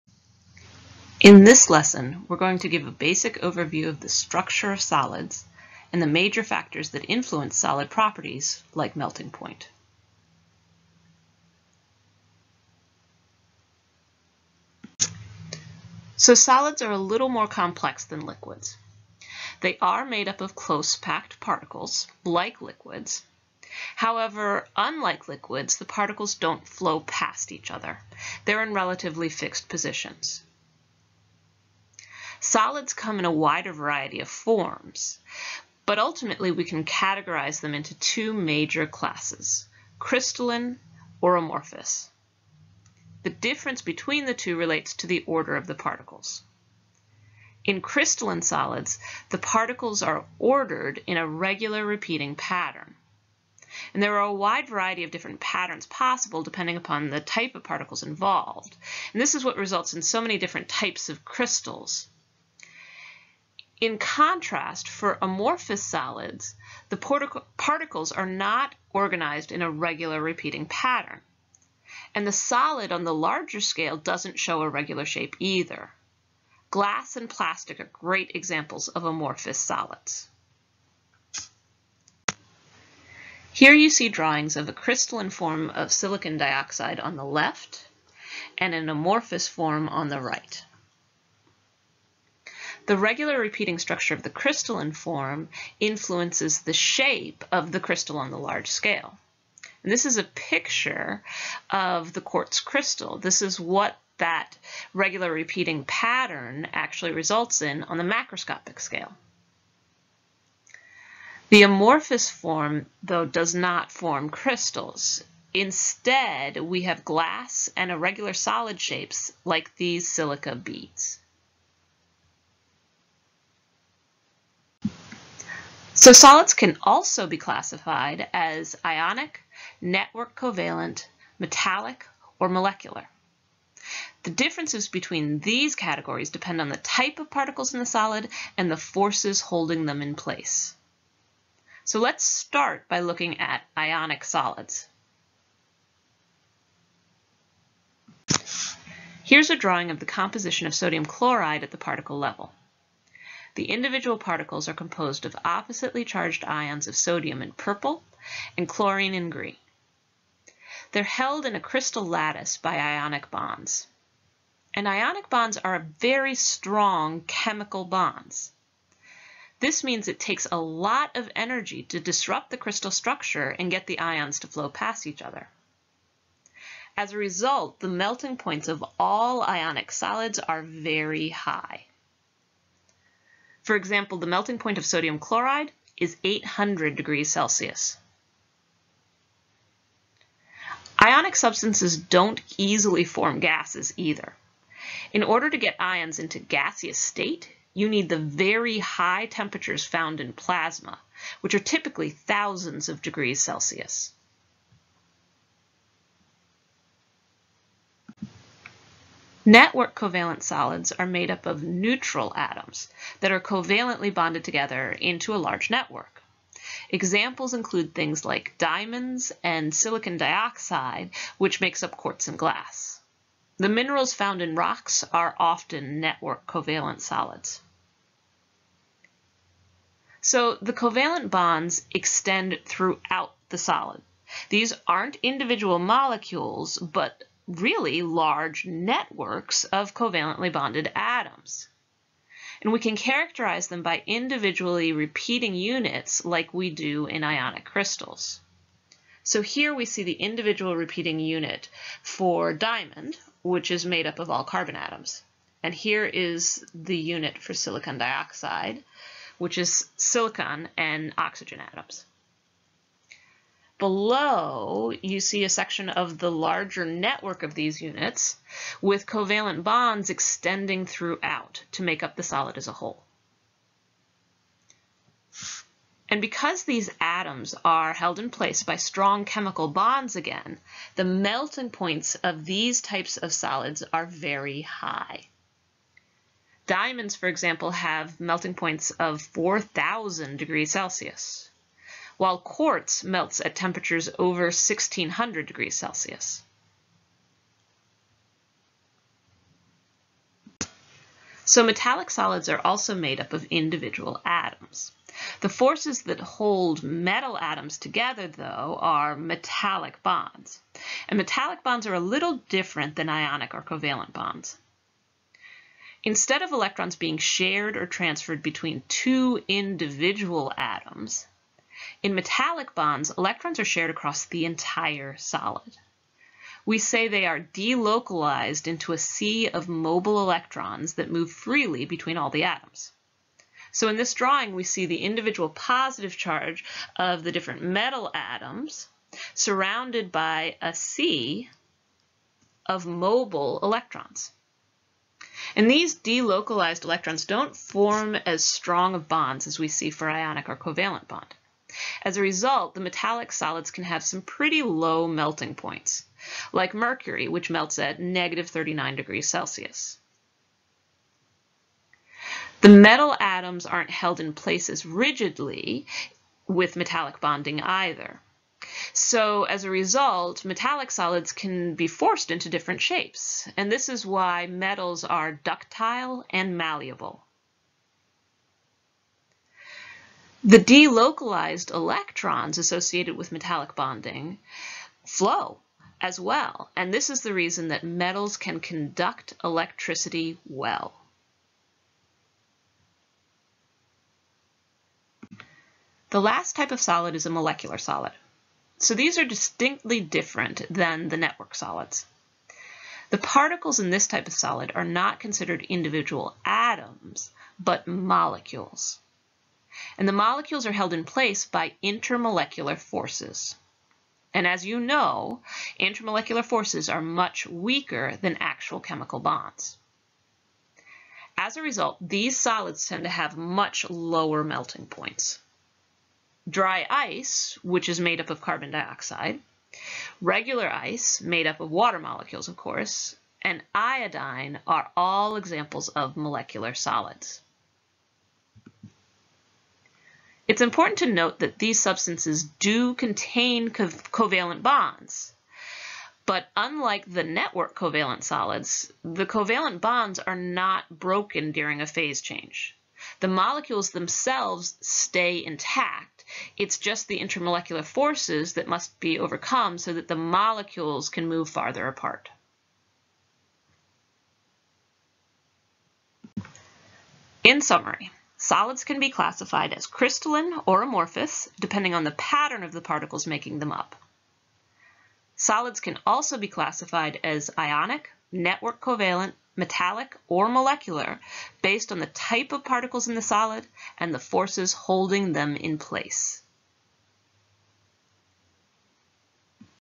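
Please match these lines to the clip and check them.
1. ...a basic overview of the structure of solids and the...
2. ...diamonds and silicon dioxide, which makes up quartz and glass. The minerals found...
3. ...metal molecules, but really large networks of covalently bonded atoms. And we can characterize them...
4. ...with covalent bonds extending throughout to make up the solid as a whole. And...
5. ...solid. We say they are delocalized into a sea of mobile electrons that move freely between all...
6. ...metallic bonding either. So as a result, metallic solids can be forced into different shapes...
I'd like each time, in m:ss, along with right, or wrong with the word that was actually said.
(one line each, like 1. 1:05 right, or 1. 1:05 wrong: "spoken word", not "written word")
1. 0:02 right
2. 3:38 right
3. 3:55 wrong: "individual", not "metal"
4. 4:28 right
5. 5:25 right
6. 6:06 right.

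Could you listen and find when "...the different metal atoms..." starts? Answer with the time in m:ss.
5:37.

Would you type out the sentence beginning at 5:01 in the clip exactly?
So metallic solids are also made up of individual atoms.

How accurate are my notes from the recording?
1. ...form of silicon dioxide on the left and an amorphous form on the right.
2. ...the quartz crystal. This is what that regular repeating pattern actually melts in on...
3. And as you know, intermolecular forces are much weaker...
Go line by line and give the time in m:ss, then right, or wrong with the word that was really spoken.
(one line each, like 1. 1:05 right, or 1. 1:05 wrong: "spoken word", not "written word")
1. 1:25 right
2. 1:42 wrong: "results", not "melts"
3. 6:54 right.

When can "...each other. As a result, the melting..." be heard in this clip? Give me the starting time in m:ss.
2:55.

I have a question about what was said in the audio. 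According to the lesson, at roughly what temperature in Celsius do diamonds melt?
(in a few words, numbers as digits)
4,000 degrees Celsius.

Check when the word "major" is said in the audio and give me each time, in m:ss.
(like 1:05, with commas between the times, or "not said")
0:06, 0:38.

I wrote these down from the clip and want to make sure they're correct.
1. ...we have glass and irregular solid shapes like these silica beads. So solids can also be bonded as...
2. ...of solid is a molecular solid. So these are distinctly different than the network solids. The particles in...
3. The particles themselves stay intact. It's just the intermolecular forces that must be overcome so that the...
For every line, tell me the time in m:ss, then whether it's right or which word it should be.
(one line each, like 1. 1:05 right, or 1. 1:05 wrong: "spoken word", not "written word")
1. 1:56 wrong: "classified", not "bonded"
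2. 6:36 right
3. 7:33 wrong: "molecules", not "particles".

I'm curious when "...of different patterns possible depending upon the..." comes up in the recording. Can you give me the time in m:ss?
0:55.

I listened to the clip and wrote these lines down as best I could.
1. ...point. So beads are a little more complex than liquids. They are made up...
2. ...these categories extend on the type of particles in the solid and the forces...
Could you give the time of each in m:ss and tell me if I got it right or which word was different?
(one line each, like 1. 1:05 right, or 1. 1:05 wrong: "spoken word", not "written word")
1. 0:09 wrong: "solids", not "beads"
2. 2:15 wrong: "depend", not "extend".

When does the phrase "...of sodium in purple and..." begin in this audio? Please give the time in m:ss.
2:36.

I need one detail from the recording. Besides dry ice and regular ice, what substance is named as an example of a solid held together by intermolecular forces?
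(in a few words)
iodine.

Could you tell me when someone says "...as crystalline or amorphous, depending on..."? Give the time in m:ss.
7:49.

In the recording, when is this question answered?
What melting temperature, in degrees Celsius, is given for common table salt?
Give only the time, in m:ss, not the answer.
3:06.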